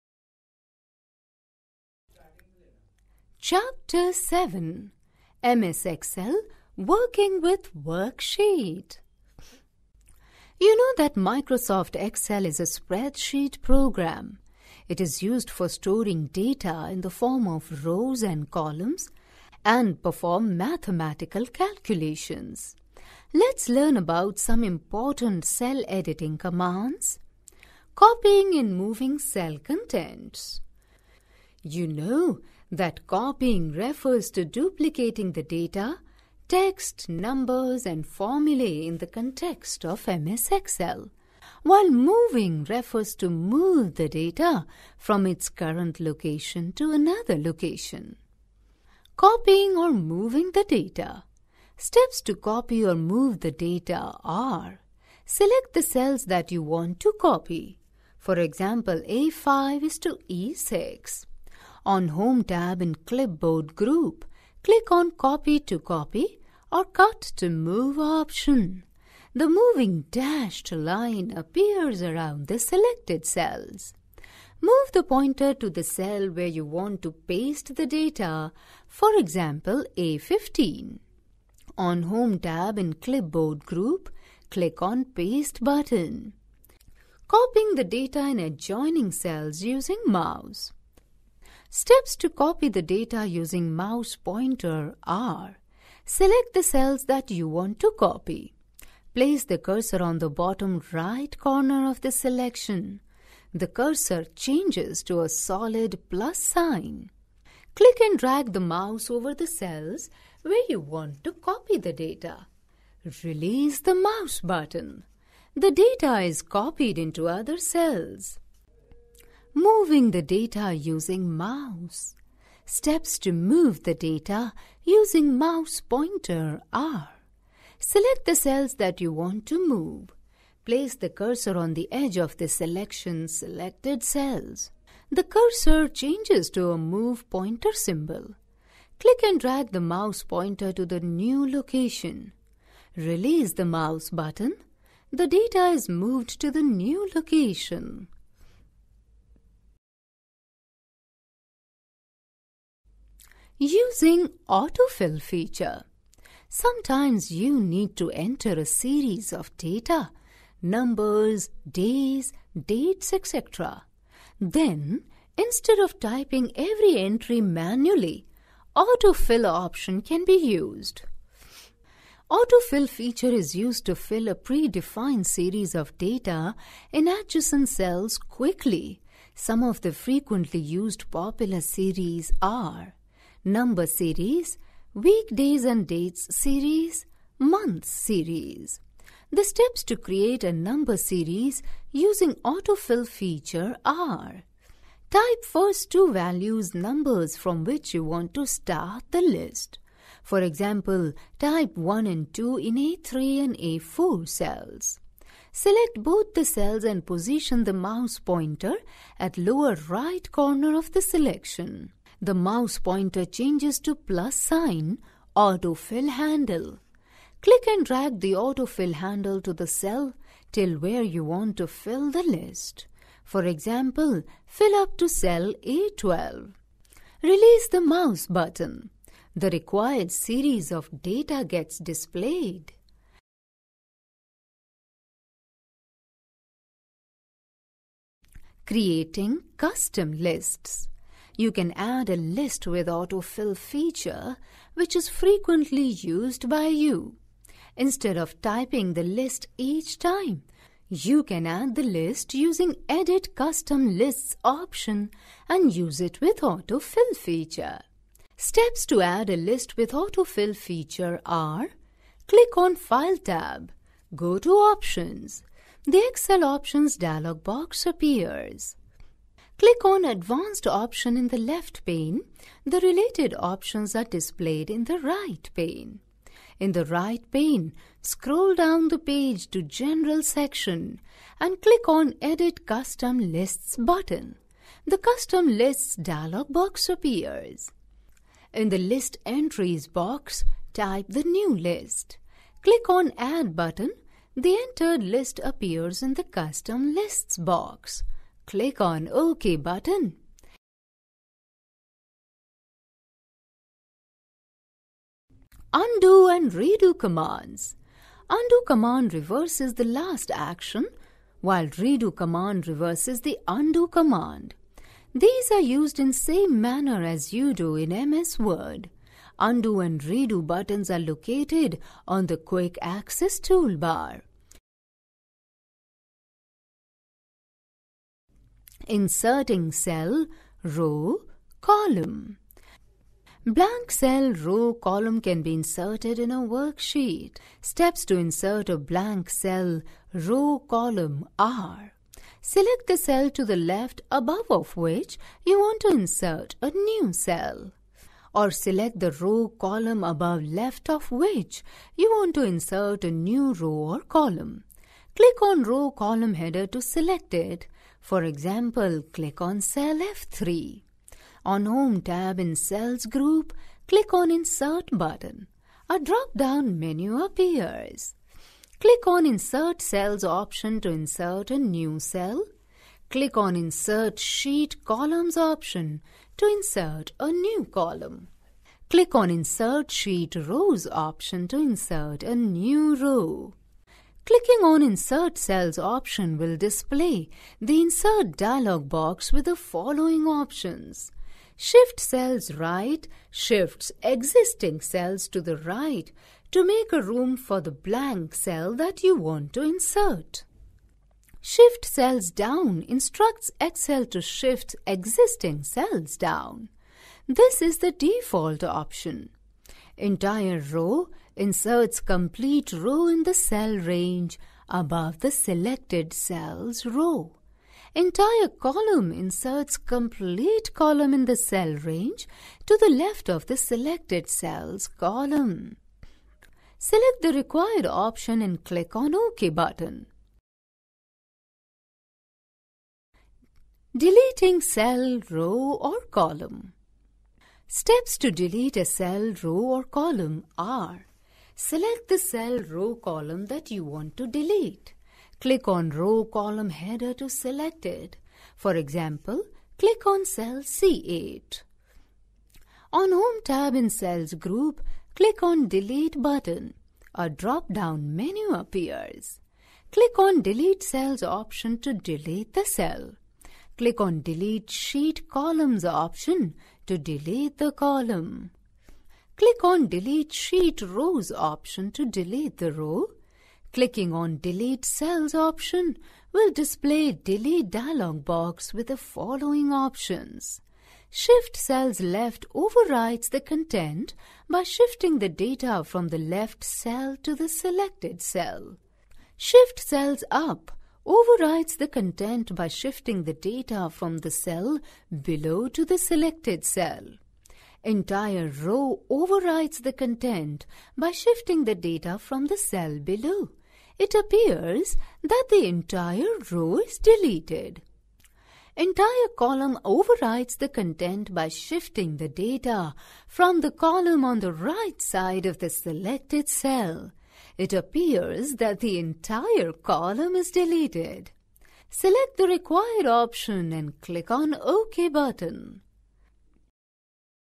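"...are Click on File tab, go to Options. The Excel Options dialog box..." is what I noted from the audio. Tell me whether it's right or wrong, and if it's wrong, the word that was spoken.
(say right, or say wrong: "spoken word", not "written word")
right.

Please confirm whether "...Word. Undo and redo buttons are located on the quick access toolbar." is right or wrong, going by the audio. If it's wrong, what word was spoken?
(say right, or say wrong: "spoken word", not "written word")
right.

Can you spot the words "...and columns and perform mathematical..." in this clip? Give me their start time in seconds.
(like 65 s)
18 s.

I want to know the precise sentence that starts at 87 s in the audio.
Copying the data in adjoining cells using mouse.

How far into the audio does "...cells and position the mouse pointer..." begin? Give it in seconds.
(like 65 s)
206 s.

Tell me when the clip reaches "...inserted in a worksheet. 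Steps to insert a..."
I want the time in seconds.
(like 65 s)
335 s.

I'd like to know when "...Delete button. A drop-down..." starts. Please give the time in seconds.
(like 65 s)
455 s.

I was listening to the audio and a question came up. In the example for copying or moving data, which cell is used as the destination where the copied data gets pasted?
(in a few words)
A15.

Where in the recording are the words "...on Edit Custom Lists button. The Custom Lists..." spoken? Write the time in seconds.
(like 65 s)
281 s.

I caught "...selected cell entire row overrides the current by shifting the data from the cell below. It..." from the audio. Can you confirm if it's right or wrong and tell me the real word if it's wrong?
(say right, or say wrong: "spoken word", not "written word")
wrong: "content", not "current".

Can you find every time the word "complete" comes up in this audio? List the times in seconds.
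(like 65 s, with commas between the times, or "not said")
412 s, 419 s.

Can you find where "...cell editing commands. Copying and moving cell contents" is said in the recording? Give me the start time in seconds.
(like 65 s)
25 s.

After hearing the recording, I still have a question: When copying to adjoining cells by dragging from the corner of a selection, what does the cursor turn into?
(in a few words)
solid plus sign.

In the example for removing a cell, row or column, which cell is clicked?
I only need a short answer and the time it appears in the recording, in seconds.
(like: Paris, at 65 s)
C8, at 450 s.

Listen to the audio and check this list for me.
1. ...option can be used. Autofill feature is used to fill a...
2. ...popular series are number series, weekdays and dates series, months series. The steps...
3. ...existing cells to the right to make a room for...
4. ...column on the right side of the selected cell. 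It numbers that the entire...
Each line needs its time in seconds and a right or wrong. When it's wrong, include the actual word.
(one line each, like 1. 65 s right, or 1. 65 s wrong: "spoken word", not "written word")
1. 169 s right
2. 181 s right
3. 394 s right
4. 513 s wrong: "appears", not "numbers".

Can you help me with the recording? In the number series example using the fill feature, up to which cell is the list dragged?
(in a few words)
A12.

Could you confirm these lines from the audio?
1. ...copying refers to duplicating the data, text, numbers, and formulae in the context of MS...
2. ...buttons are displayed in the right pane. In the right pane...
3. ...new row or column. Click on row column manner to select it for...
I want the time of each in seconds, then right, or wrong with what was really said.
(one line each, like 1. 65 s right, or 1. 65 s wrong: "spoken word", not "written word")
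1. 33 s right
2. 273 s wrong: "options", not "buttons"
3. 353 s wrong: "header", not "manner".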